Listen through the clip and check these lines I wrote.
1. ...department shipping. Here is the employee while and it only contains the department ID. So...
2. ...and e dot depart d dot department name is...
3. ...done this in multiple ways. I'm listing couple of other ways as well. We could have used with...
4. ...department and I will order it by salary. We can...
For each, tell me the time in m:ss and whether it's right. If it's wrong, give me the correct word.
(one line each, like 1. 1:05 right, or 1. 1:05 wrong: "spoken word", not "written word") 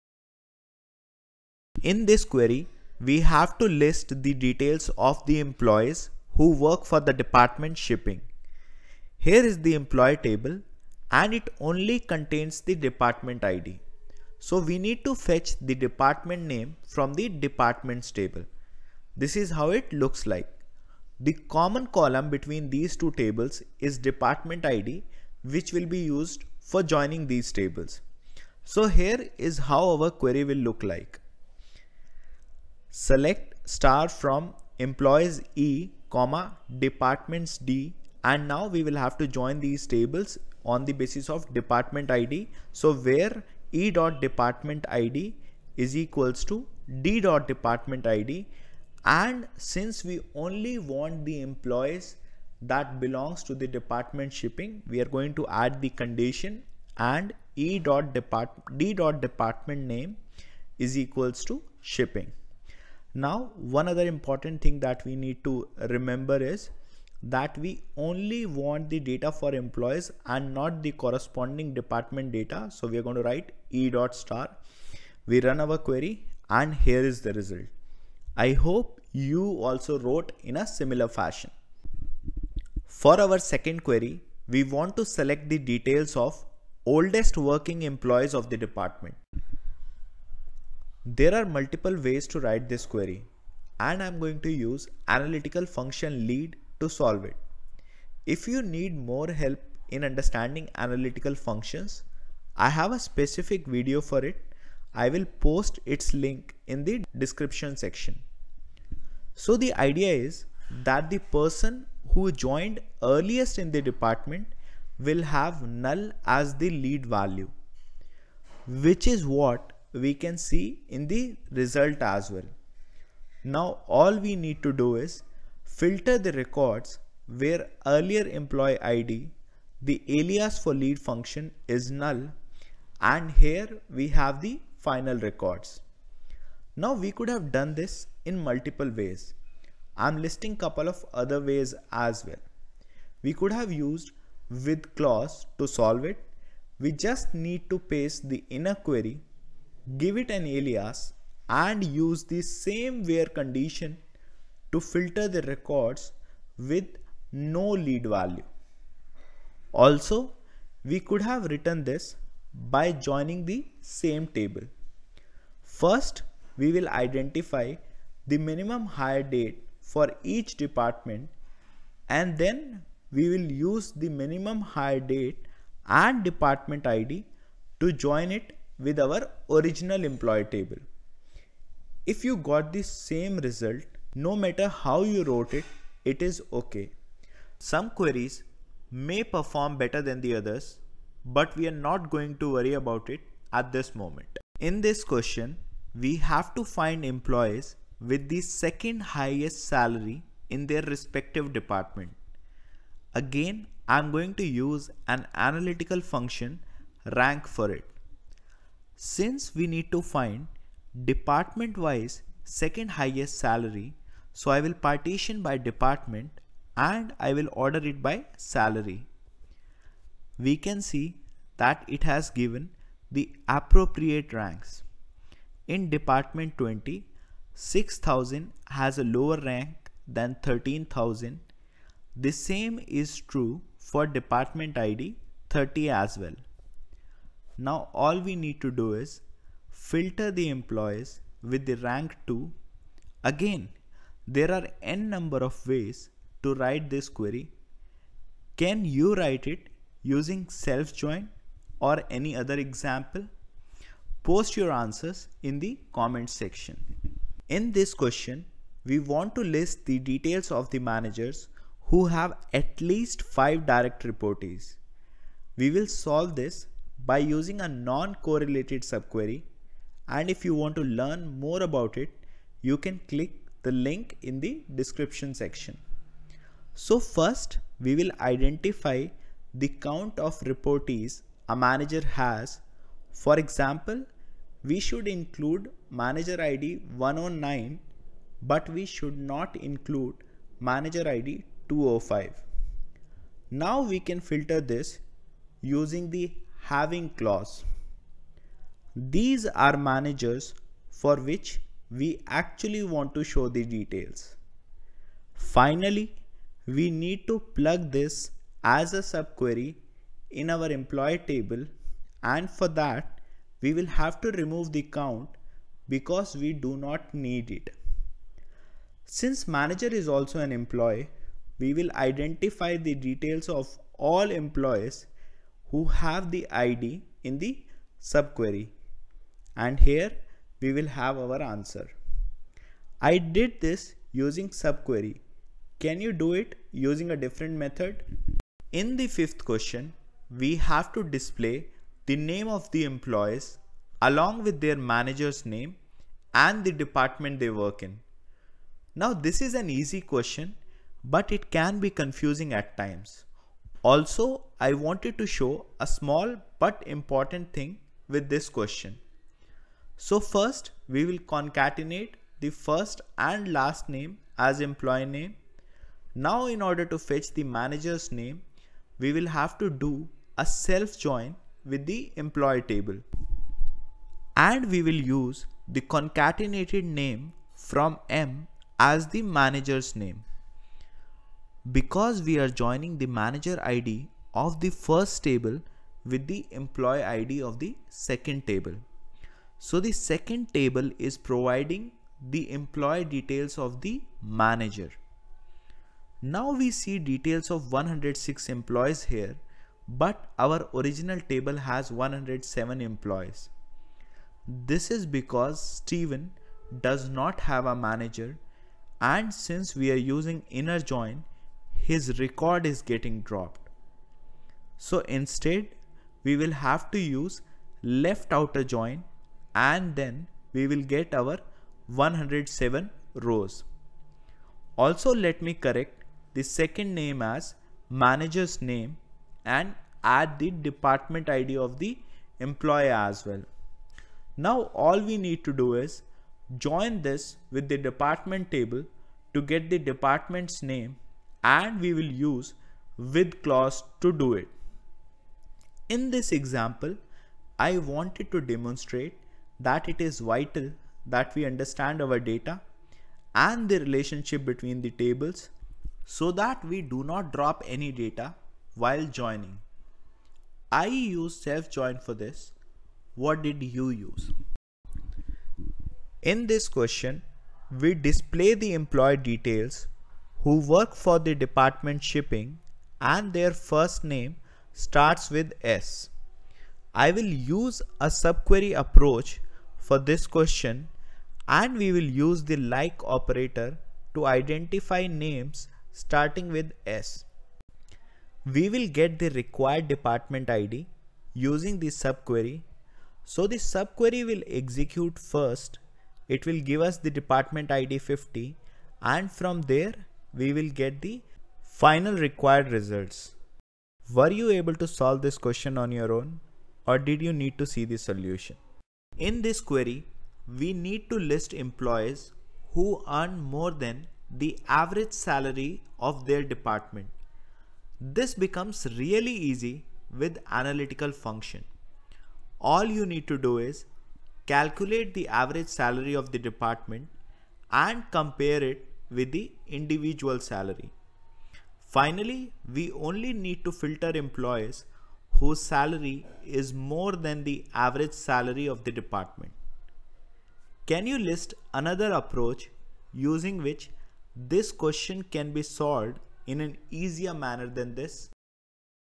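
1. 0:07 wrong: "table", not "while"
2. 0:56 right
3. 2:17 right
4. 3:35 right.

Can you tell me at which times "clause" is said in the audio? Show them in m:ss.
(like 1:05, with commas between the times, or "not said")
2:24, 4:57, 7:23.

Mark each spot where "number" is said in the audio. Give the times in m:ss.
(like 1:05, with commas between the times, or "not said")
4:05.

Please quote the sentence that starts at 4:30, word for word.
And if you want to learn more about it, you can click the link in the description section.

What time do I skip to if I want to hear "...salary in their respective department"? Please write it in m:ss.
3:19.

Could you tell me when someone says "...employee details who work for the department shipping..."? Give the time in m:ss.
7:48.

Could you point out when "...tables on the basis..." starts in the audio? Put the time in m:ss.
0:39.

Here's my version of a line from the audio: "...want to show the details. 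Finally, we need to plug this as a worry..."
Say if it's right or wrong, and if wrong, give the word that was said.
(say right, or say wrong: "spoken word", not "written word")
wrong: "subquery", not "worry".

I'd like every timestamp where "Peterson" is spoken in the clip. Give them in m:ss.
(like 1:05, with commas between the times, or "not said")
not said.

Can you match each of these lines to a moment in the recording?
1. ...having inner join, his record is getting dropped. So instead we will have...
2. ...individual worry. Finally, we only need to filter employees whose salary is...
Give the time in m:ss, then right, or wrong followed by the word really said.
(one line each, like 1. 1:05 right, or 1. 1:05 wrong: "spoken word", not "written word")
1. 6:49 wrong: "using", not "having"
2. 8:49 wrong: "salary", not "worry".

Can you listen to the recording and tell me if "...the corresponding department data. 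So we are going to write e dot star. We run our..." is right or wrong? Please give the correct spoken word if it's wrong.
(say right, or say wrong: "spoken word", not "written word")
right.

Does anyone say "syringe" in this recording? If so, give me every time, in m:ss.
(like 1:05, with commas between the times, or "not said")
not said.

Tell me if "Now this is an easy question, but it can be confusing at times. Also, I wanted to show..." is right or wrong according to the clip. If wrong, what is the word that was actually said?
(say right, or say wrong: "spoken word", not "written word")
right.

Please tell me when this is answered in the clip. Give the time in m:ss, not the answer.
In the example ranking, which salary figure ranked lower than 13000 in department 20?
3:47.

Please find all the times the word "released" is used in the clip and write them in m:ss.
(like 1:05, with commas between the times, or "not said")
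not said.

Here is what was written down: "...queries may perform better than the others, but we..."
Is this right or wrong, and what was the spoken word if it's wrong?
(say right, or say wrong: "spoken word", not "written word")
right.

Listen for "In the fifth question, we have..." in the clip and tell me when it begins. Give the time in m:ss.
5:38.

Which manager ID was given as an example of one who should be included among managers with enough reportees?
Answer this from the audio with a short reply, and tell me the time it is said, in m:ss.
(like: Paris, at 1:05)
109, at 4:46.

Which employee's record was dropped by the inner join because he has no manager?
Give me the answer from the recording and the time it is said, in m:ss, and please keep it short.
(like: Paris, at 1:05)
Steven, at 6:45.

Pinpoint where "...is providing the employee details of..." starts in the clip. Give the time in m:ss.
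6:30.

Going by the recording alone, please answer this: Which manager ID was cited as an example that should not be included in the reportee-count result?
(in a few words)
205.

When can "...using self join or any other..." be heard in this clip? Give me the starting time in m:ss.
4:10.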